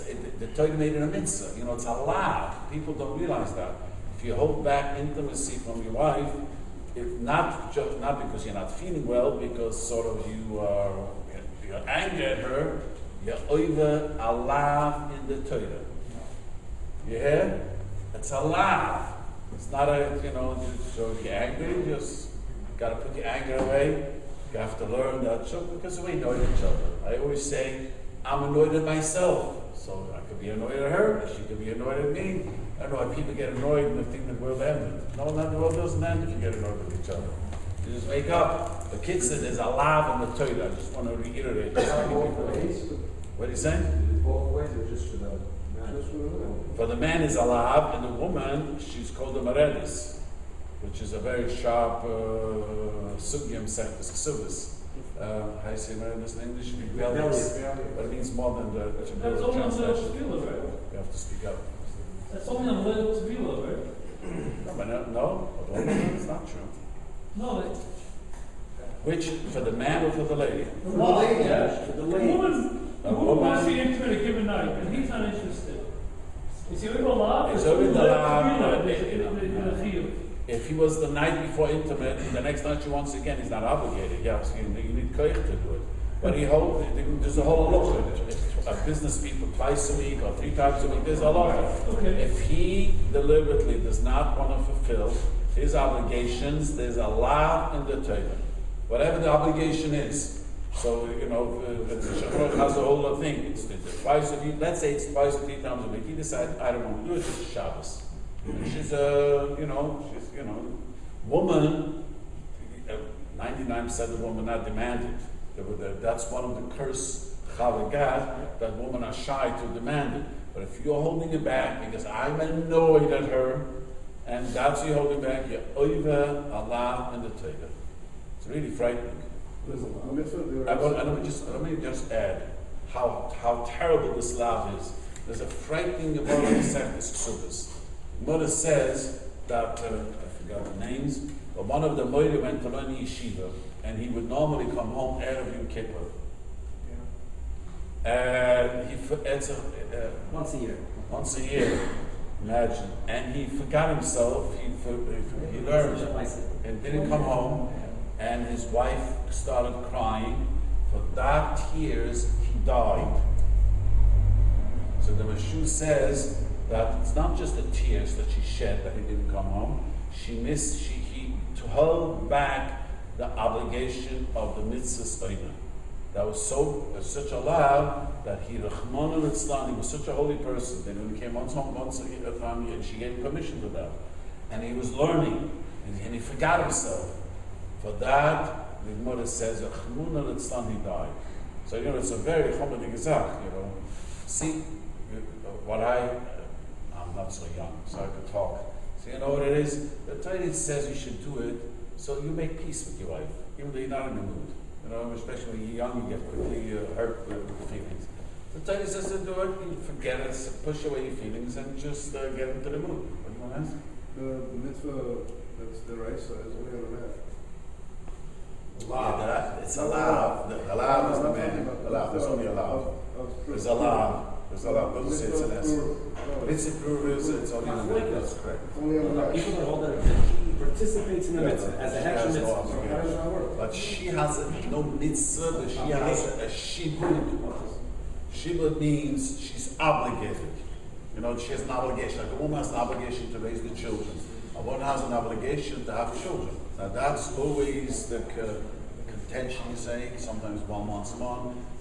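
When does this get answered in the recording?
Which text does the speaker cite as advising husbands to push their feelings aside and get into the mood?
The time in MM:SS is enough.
03:28.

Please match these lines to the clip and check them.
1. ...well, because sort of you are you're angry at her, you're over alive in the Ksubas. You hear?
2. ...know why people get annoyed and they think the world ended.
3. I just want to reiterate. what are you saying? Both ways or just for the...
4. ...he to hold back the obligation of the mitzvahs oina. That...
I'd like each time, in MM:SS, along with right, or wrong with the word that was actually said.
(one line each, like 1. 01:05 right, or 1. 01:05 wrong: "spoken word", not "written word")
1. 00:09 wrong: "Torah", not "Ksubas"
2. 00:32 right
3. 00:40 right
4. 02:50 right.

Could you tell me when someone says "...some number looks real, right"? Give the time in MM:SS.
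01:02.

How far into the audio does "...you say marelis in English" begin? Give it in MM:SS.
00:55.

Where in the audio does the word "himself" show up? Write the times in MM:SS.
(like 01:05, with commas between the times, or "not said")
02:33, 03:06.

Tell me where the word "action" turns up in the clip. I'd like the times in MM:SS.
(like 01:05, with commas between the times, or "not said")
03:52.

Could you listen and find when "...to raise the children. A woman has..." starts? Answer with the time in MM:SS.
04:03.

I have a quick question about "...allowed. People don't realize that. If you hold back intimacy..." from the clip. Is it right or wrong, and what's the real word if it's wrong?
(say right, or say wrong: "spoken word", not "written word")
right.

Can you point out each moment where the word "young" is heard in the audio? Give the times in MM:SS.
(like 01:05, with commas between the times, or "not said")
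03:17, 03:25.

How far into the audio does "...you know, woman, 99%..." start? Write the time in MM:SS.
01:50.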